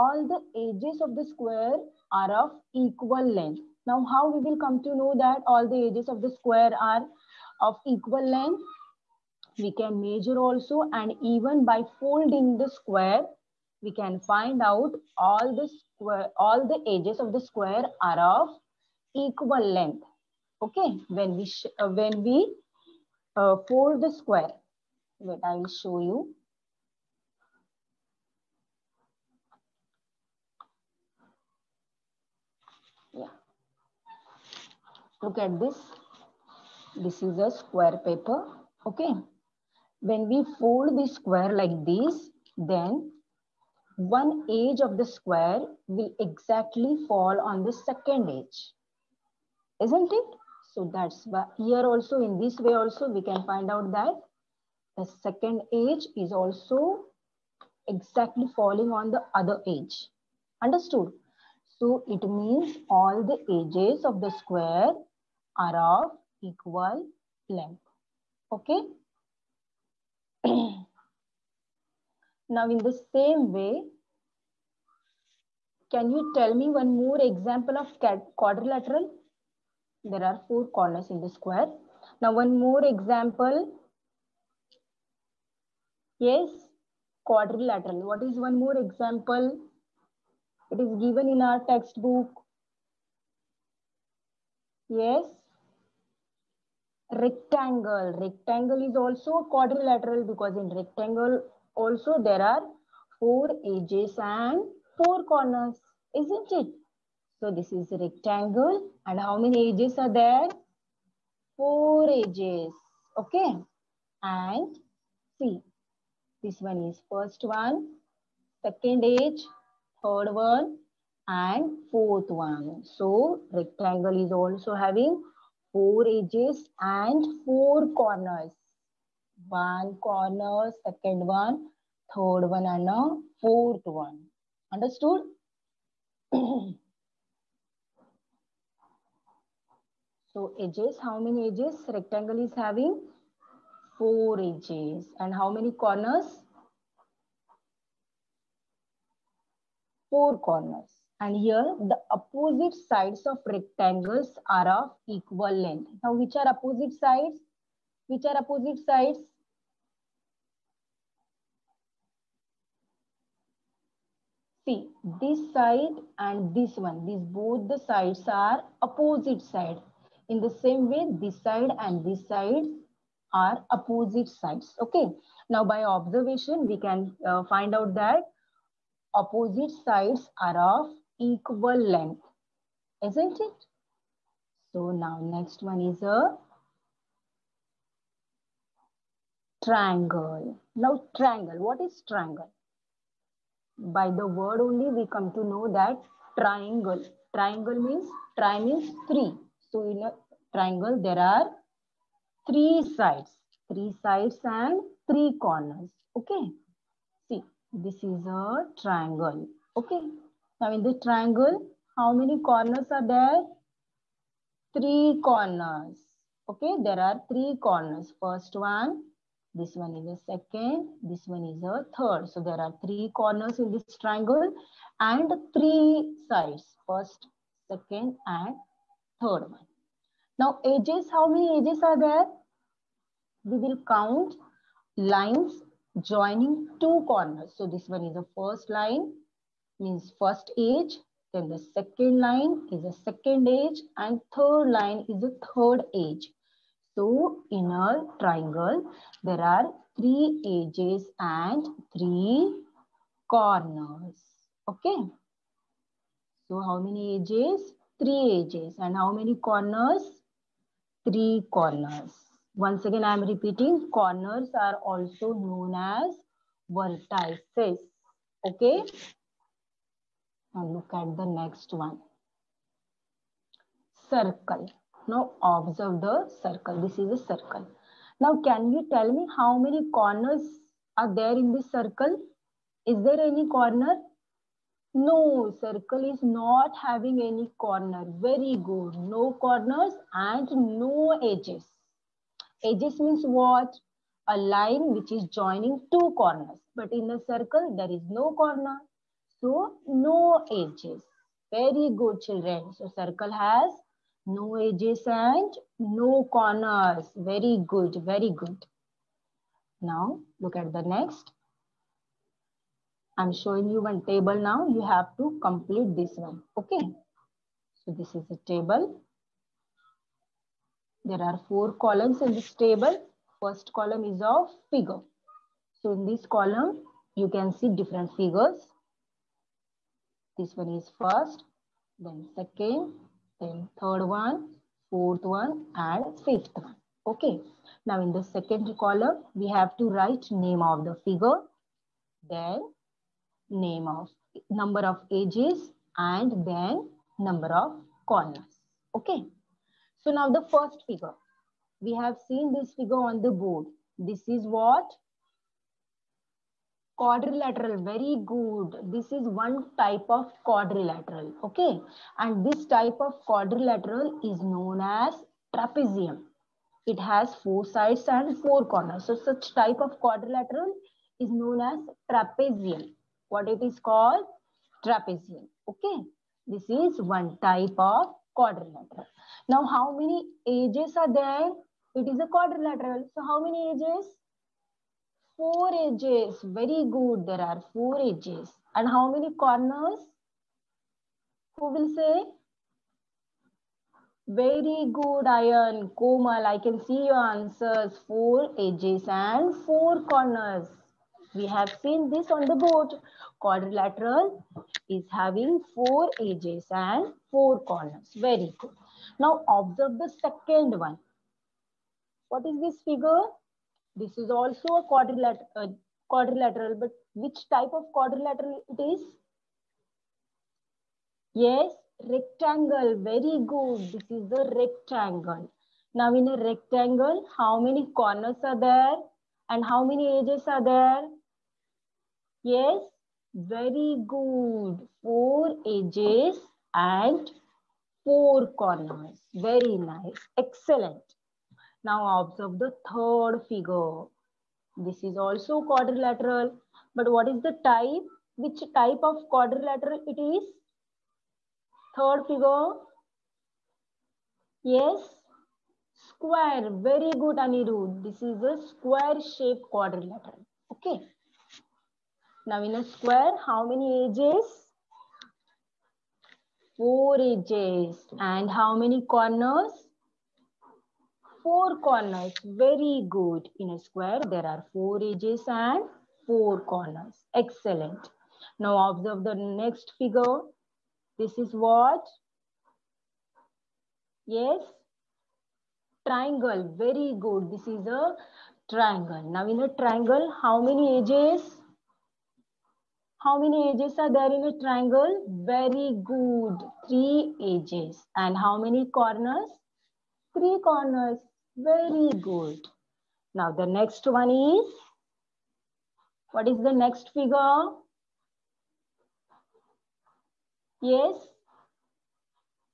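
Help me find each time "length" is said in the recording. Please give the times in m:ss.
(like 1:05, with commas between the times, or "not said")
0:03, 0:08, 0:19, 1:07, 2:35, 3:01.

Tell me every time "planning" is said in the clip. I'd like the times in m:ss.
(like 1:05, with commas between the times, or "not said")
not said.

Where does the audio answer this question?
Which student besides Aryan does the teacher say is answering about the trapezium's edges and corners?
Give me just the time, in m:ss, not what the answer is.
6:36.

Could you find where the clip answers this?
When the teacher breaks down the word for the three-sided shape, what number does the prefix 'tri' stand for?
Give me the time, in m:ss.
3:18.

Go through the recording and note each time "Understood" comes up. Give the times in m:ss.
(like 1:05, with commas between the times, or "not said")
1:00, 2:14.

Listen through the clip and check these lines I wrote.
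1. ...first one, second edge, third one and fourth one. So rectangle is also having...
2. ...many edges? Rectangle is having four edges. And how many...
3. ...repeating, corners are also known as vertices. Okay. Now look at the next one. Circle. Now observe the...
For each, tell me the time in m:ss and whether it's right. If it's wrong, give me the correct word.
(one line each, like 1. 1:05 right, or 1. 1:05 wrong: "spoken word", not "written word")
1. 1:57 right
2. 2:21 right
3. 4:23 right.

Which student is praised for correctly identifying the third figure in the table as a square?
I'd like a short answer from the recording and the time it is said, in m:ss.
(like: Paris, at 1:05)
Anirudh, at 7:37.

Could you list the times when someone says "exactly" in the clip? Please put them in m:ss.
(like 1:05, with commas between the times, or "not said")
0:46, 0:57.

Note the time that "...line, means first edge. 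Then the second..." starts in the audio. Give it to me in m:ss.
3:58.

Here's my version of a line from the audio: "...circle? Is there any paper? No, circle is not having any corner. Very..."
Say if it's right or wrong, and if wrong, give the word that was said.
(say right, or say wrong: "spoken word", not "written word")
wrong: "corner", not "paper".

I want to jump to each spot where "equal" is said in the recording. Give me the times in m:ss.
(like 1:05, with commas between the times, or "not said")
0:02, 0:07, 0:19, 1:06, 2:35, 3:01.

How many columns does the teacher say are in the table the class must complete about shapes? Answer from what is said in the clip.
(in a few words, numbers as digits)
4.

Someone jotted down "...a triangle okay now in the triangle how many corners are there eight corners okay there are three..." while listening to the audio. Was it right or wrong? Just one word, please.
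wrong.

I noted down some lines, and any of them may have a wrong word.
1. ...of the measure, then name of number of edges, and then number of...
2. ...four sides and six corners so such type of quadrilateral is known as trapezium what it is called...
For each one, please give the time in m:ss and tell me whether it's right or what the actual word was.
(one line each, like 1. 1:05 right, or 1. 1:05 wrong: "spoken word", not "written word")
1. 5:40 wrong: "figure", not "measure"
2. 6:07 wrong: "four", not "six".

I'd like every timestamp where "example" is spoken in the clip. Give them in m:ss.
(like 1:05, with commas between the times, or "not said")
1:17, 1:22, 1:28.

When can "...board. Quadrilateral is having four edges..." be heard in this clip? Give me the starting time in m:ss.
6:42.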